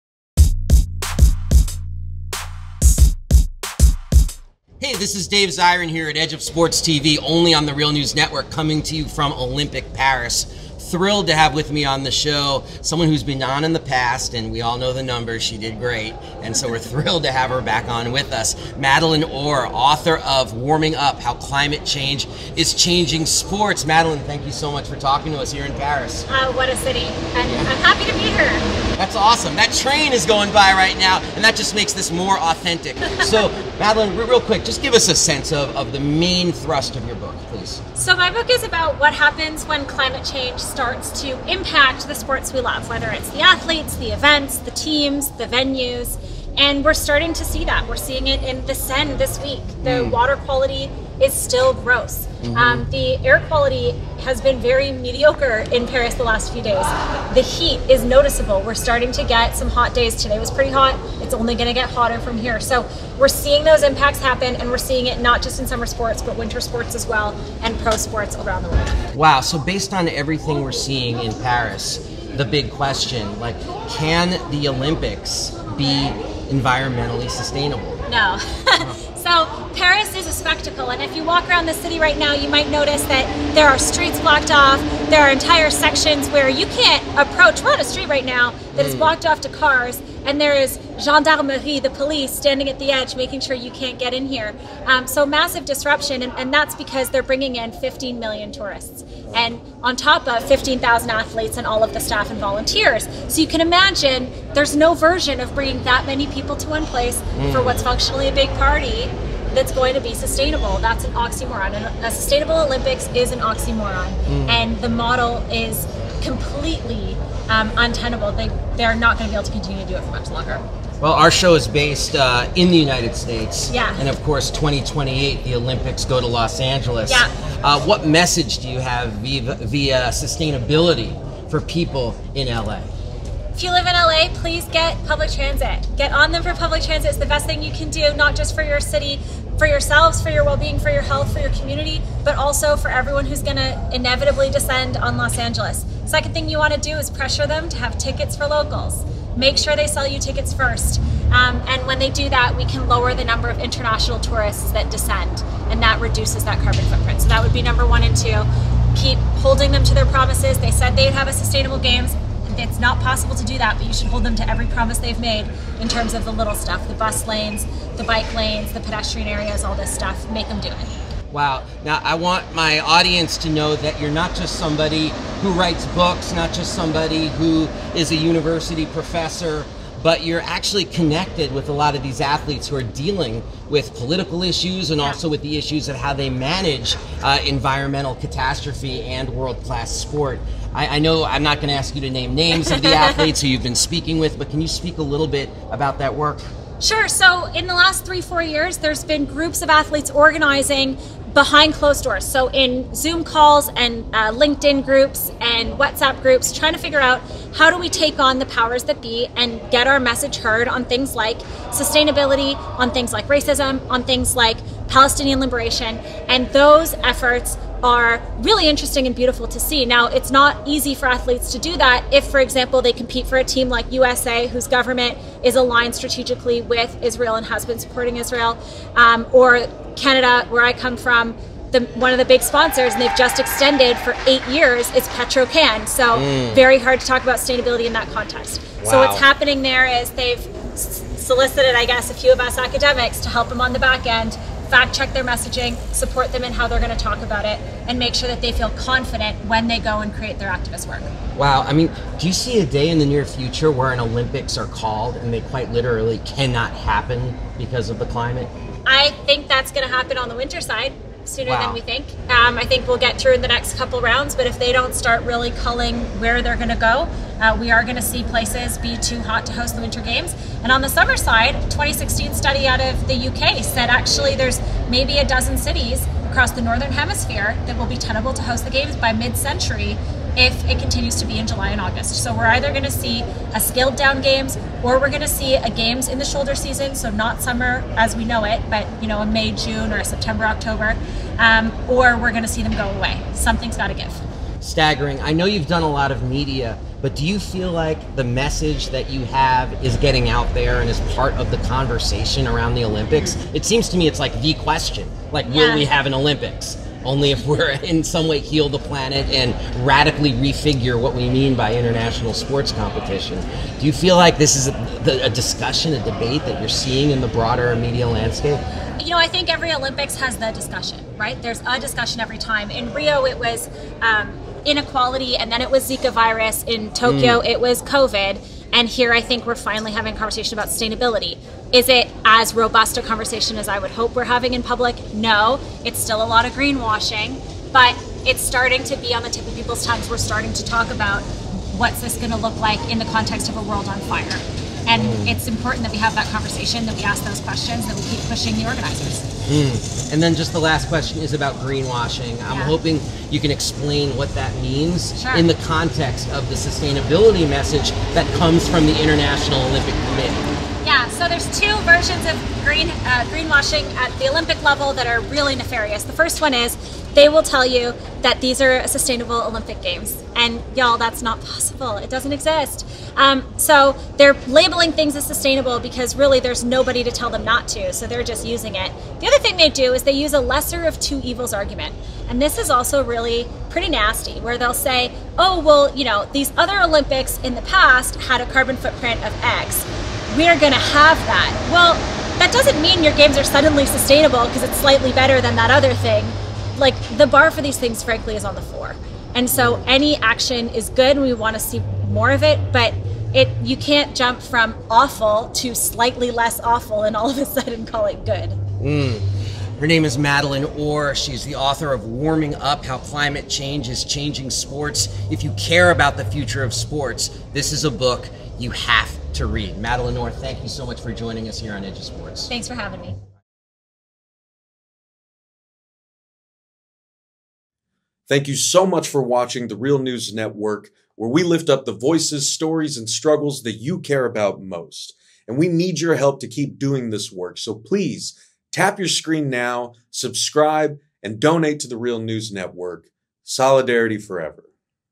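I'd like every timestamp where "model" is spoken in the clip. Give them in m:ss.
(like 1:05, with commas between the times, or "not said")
1:54.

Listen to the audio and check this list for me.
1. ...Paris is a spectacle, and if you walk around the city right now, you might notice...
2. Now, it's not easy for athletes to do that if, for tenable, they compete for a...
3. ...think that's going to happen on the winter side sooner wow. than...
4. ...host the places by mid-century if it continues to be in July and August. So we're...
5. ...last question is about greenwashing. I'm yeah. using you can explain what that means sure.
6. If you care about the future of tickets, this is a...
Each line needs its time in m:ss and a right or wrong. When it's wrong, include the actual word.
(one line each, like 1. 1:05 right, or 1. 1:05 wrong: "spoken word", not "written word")
1. 1:19 right
2. 3:39 wrong: "example", not "tenable"
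3. 4:19 right
4. 4:38 wrong: "games", not "places"
5. 5:50 wrong: "hoping", not "using"
6. 6:55 wrong: "sports", not "tickets".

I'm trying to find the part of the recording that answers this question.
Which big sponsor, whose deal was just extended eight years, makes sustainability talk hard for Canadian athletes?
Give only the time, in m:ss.
3:55.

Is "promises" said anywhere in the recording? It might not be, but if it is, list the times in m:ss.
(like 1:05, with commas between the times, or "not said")
2:40, 2:44.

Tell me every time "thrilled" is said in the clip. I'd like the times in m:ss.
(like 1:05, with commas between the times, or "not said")
0:10, 0:16.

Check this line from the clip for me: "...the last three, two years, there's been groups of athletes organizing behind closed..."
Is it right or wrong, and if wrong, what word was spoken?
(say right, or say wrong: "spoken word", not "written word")
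wrong: "four", not "two".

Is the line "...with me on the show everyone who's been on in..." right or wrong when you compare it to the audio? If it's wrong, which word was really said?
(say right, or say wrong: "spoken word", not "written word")
wrong: "someone", not "everyone".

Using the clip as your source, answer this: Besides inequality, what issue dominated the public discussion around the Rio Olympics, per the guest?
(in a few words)
Zika virus.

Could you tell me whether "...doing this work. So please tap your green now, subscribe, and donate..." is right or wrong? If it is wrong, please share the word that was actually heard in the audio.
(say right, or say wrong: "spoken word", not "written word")
wrong: "screen", not "green".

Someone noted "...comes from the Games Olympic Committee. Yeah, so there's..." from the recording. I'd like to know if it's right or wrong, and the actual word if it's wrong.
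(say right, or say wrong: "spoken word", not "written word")
wrong: "International", not "Games".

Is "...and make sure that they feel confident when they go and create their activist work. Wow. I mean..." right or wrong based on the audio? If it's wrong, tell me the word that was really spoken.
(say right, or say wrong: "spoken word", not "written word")
right.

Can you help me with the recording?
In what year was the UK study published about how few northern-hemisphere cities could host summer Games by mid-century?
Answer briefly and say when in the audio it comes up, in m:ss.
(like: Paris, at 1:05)
2016, at 4:31.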